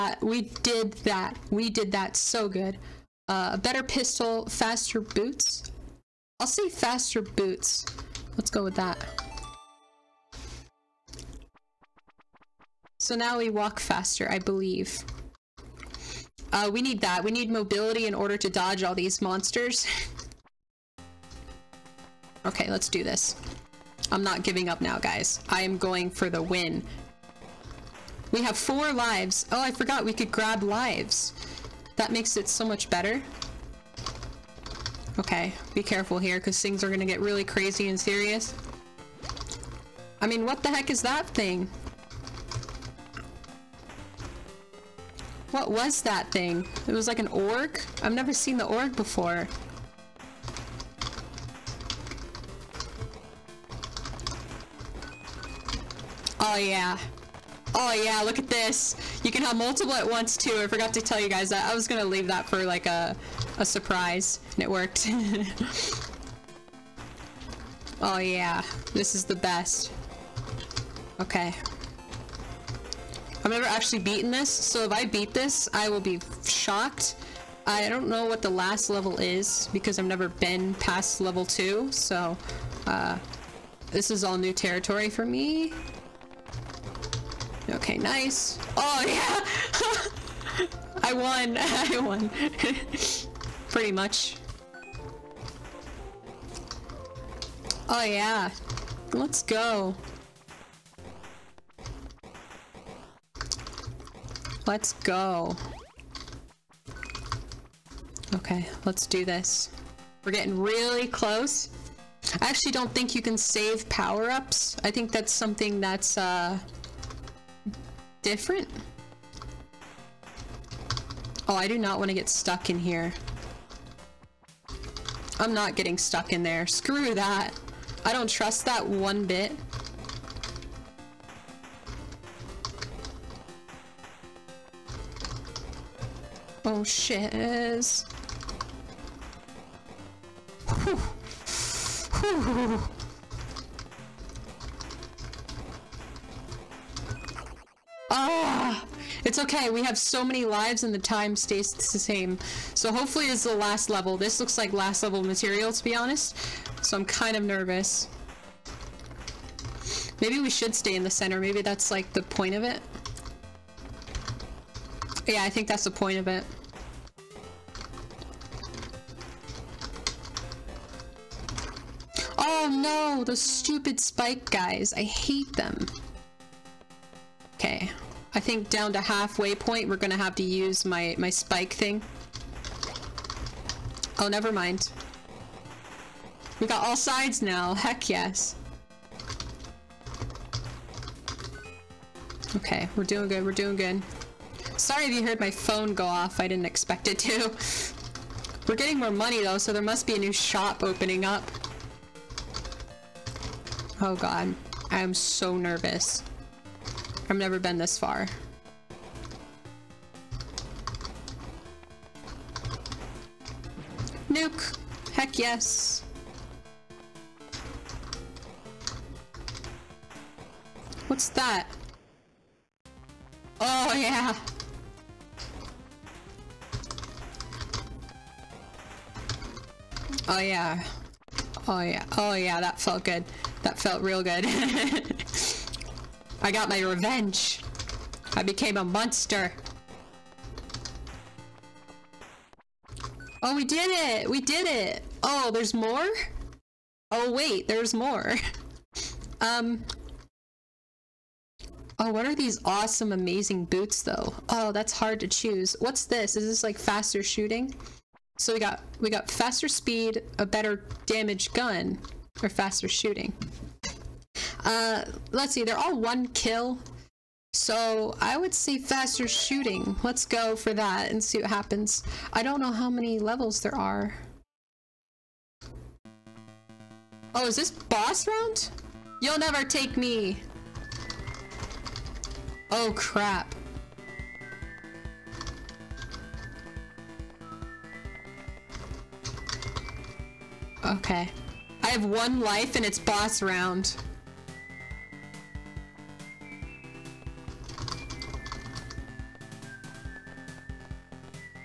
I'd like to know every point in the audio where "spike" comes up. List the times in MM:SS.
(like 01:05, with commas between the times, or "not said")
02:53, 03:01.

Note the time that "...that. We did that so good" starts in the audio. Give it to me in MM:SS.
00:01.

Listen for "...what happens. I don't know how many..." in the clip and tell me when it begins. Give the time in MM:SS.
04:31.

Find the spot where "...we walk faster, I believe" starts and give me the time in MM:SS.
00:13.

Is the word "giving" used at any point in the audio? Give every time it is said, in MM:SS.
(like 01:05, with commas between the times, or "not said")
00:24.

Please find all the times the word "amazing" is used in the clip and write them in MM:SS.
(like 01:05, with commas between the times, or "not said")
04:13.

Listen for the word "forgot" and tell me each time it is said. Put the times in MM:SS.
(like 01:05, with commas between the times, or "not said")
00:29, 01:00.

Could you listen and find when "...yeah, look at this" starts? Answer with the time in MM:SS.
00:57.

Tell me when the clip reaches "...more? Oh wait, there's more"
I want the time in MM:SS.
04:05.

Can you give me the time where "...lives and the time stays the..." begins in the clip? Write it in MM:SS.
02:30.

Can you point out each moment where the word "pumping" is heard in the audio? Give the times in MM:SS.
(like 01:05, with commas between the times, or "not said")
not said.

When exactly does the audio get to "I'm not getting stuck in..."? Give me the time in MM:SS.
02:05.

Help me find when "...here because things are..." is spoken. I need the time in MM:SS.
00:36.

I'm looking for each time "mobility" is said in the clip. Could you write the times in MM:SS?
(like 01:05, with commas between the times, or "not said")
00:17.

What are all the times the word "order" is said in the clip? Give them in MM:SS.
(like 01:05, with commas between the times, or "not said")
00:18.